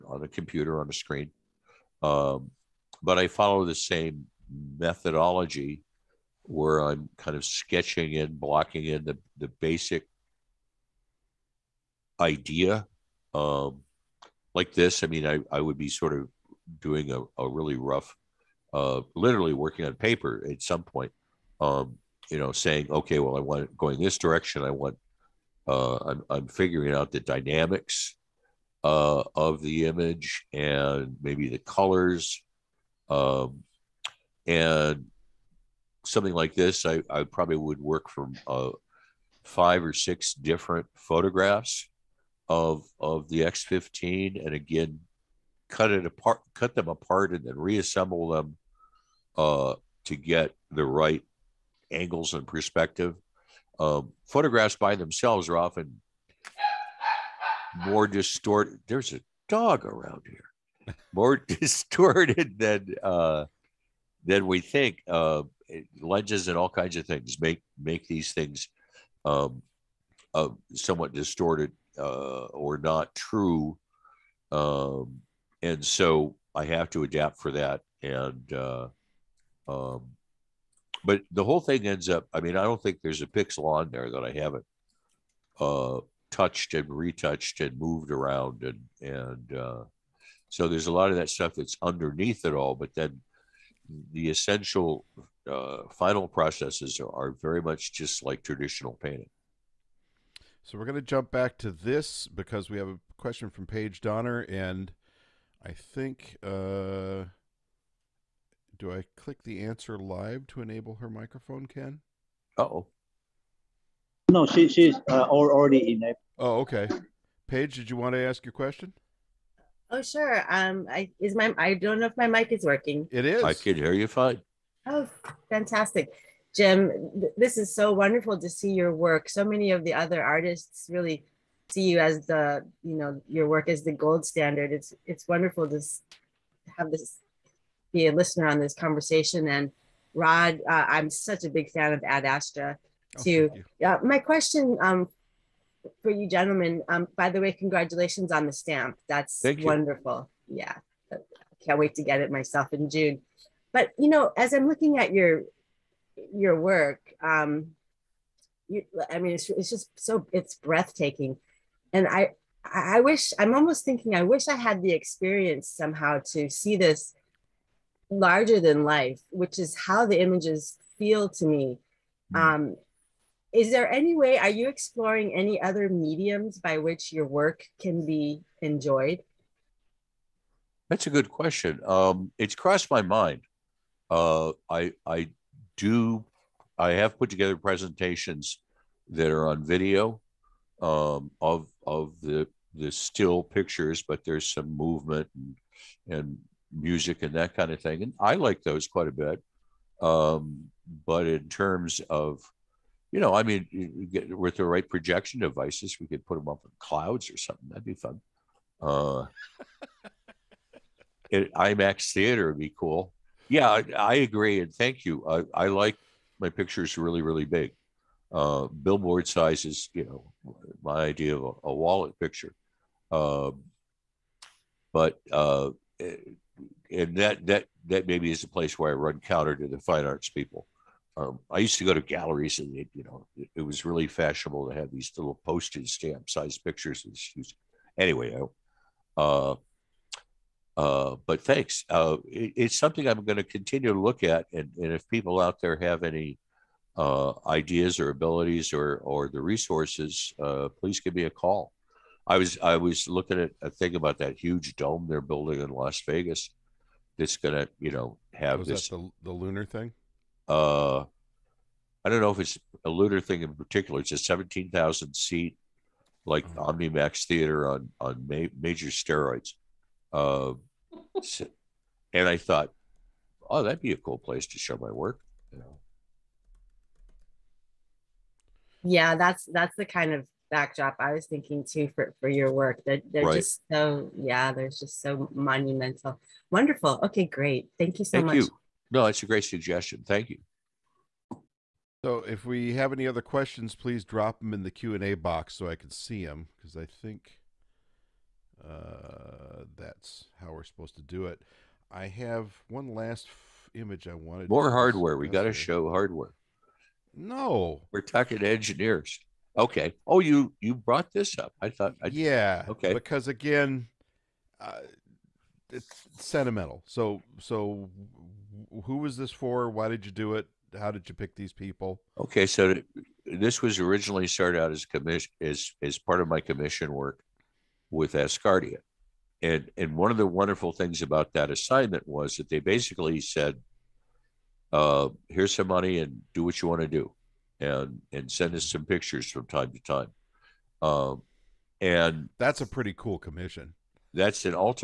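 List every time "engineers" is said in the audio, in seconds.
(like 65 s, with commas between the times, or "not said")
308 s.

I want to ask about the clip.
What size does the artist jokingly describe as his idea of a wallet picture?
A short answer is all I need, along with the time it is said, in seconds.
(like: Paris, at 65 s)
Billboard size, at 218 s.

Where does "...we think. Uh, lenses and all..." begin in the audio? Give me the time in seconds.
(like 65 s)
64 s.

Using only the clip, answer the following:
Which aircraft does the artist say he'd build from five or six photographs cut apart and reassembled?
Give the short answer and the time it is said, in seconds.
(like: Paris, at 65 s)
X15, at 43 s.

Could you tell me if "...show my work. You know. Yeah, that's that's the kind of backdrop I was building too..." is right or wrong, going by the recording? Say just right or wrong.
wrong.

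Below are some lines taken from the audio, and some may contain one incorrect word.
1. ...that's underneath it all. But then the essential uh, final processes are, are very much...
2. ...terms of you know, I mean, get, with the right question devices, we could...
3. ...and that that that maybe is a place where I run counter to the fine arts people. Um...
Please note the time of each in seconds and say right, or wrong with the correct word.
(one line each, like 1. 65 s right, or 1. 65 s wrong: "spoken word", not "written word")
1. 91 s right
2. 201 s wrong: "projection", not "question"
3. 226 s right.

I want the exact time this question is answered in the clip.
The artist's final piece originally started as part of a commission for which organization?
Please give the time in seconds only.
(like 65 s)
328 s.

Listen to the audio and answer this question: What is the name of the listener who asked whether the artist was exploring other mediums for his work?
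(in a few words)
Paige Donner.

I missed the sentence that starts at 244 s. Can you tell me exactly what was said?
And, and if people out there have any uh, ideas or abilities or, or the resources, uh, please give me a call.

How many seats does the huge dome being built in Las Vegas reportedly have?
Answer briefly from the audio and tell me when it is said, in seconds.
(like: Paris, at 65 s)
17,000, at 264 s.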